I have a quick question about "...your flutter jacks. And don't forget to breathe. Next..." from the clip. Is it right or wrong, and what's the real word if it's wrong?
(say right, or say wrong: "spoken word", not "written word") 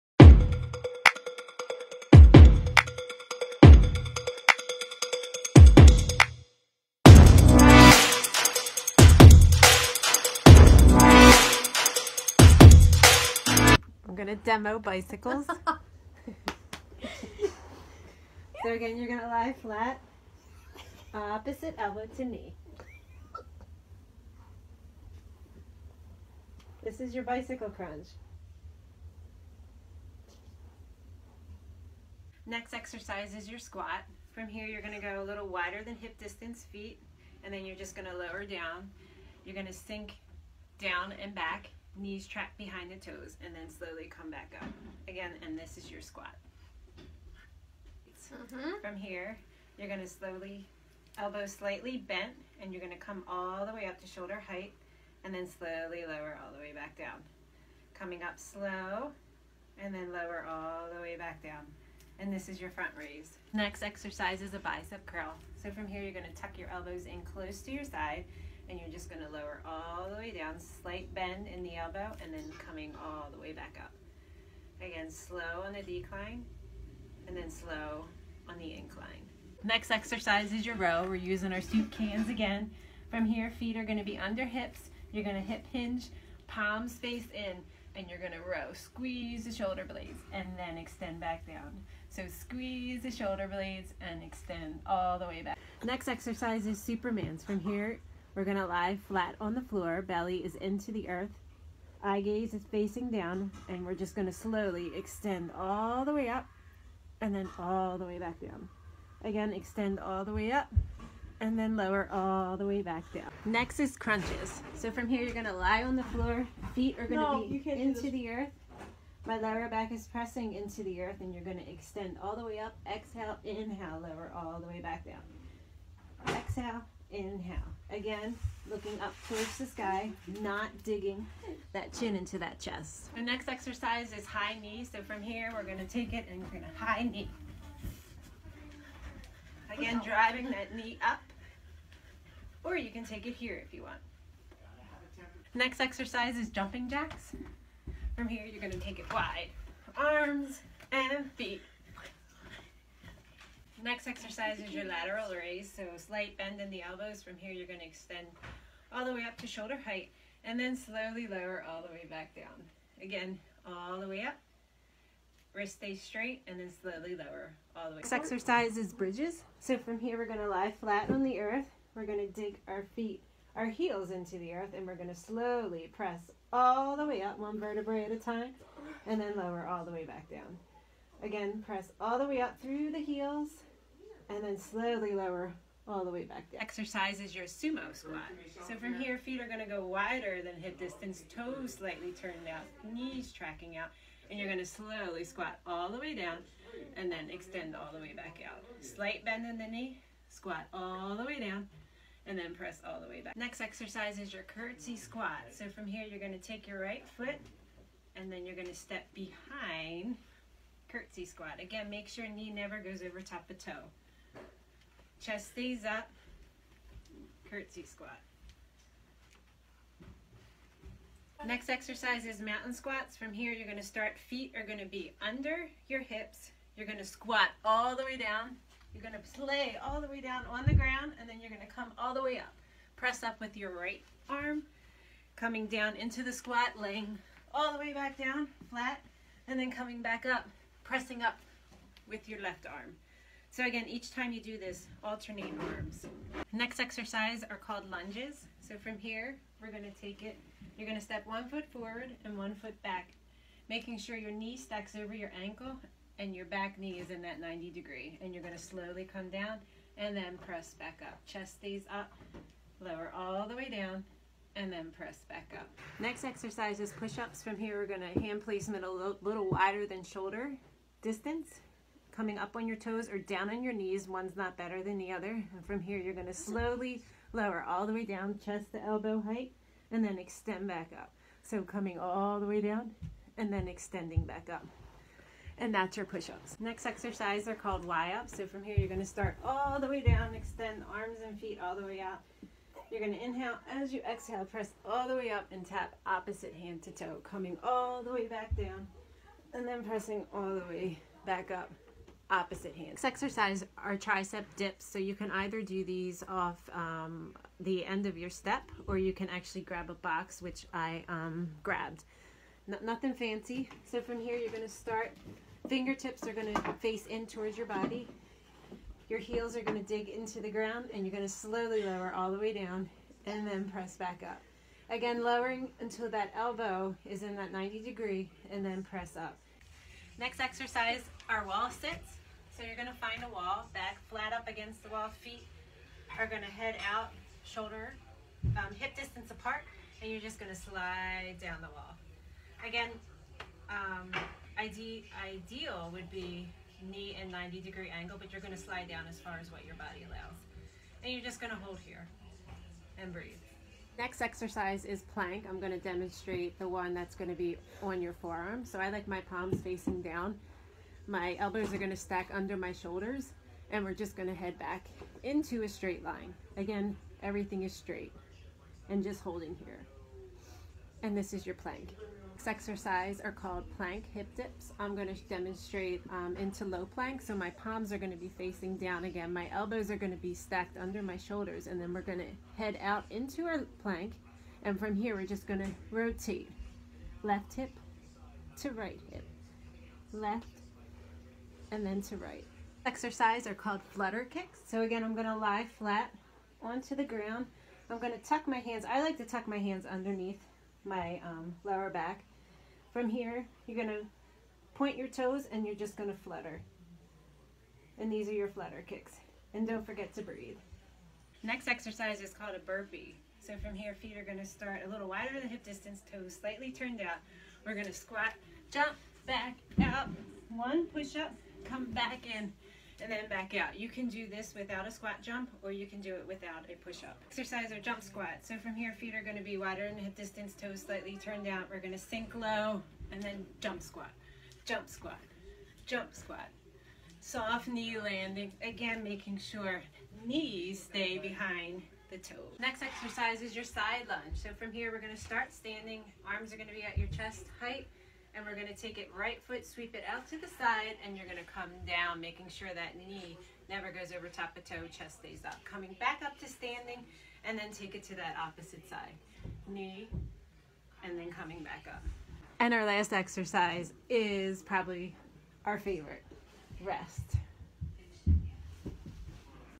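wrong: "kicks", not "jacks".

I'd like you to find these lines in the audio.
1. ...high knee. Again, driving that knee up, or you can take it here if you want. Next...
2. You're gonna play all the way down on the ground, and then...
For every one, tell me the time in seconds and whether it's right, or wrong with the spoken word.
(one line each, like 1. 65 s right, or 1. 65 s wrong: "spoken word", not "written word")
1. 136 s right
2. 228 s right.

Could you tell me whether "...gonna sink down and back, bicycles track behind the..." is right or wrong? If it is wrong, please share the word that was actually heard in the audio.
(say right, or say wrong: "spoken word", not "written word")
wrong: "knees", not "bicycles".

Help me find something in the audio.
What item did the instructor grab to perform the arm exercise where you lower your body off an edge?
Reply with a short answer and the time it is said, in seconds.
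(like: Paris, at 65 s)
a box, at 309 s.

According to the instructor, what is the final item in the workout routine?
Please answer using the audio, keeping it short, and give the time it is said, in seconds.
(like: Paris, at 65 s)
rest, at 466 s.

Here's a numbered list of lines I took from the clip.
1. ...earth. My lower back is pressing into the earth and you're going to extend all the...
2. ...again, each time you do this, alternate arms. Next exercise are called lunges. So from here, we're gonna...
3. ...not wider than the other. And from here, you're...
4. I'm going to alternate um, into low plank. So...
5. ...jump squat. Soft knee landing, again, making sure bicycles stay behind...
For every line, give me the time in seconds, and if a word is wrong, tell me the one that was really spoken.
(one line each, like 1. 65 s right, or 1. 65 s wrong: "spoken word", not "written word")
1. 118 s right
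2. 243 s right
3. 274 s wrong: "better", not "wider"
4. 374 s wrong: "demonstrate", not "alternate"
5. 435 s wrong: "knees", not "bicycles".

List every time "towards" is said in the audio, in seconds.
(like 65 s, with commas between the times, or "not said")
129 s, 317 s.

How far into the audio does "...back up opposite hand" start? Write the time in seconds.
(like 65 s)
301 s.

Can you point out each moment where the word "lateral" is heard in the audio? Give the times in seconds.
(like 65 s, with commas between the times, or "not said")
154 s.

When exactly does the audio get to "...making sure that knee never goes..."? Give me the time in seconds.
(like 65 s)
452 s.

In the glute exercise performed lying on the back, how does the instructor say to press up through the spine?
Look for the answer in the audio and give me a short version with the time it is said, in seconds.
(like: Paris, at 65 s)
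one vertebrae at a time, at 177 s.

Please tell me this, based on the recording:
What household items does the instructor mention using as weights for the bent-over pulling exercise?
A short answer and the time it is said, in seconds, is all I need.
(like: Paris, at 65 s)
soup cans, at 81 s.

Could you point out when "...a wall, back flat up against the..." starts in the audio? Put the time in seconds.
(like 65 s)
333 s.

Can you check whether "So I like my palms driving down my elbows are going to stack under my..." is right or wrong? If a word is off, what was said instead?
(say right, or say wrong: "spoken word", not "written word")
wrong: "facing", not "driving".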